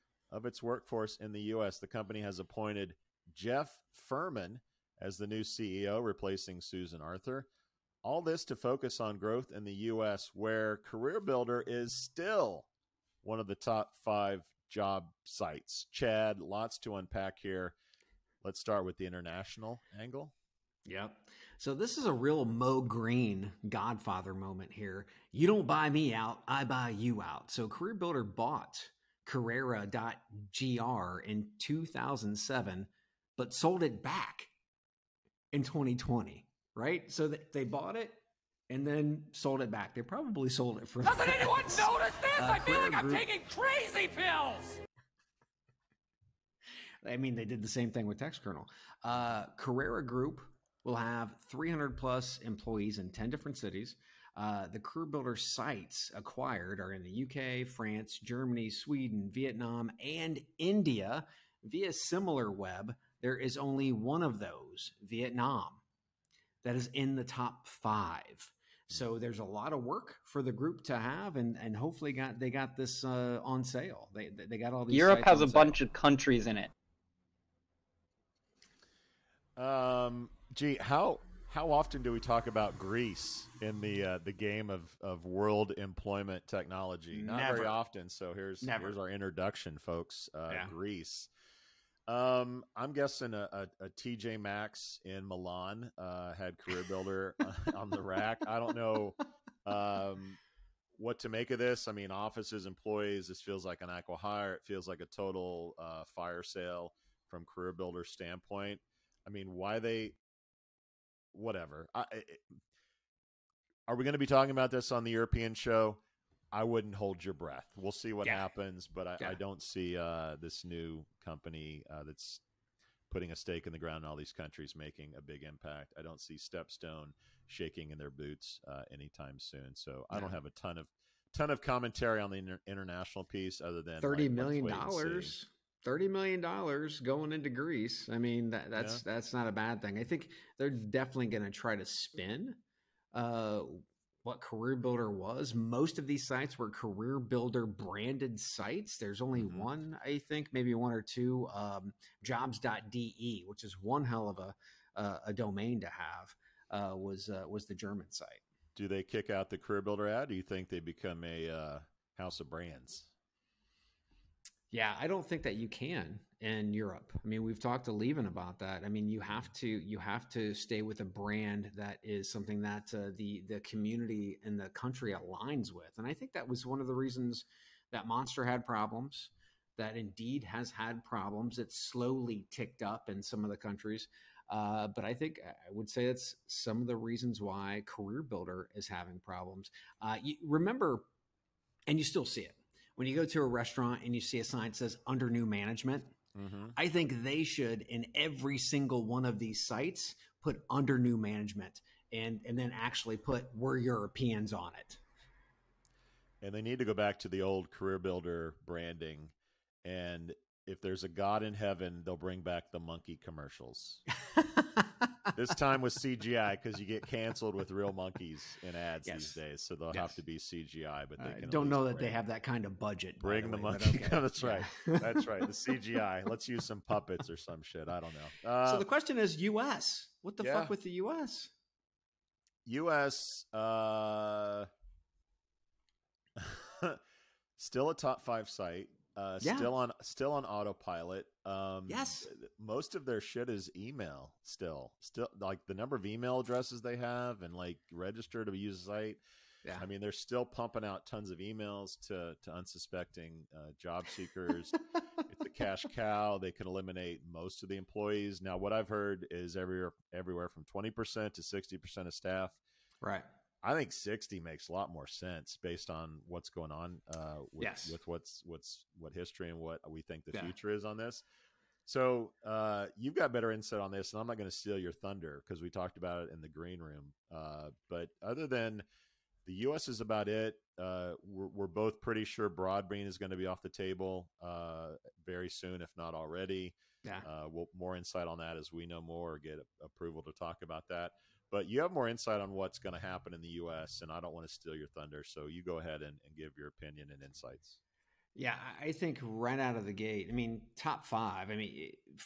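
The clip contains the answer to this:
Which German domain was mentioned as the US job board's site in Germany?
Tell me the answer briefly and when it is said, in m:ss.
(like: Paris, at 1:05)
jobs.de, at 2:32.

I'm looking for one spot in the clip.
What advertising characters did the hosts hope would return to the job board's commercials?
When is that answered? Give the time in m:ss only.
3:32.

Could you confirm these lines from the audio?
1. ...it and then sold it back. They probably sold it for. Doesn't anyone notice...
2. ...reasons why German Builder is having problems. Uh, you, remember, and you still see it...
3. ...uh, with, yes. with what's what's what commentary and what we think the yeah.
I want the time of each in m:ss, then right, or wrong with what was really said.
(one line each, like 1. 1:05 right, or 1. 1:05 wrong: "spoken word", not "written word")
1. 0:37 right
2. 3:06 wrong: "Career", not "German"
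3. 4:27 wrong: "history", not "commentary".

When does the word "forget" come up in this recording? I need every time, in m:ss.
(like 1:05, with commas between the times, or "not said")
not said.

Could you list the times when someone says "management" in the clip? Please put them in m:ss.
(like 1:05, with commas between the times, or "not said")
3:15, 3:21.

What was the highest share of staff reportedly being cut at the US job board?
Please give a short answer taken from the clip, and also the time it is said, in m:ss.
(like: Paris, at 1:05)
60 percent, at 4:21.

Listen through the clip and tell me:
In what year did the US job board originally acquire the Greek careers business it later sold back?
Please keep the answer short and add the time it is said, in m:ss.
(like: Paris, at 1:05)
2007, at 0:31.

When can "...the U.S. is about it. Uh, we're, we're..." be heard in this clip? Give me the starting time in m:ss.
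4:39.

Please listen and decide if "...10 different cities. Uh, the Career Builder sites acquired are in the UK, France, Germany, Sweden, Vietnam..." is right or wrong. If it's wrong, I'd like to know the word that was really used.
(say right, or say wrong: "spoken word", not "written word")
right.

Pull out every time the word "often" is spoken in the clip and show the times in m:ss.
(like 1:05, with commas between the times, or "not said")
1:21, 1:27.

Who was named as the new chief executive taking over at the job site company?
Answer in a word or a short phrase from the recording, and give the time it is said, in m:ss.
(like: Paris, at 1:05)
Jeff Furman, at 0:03.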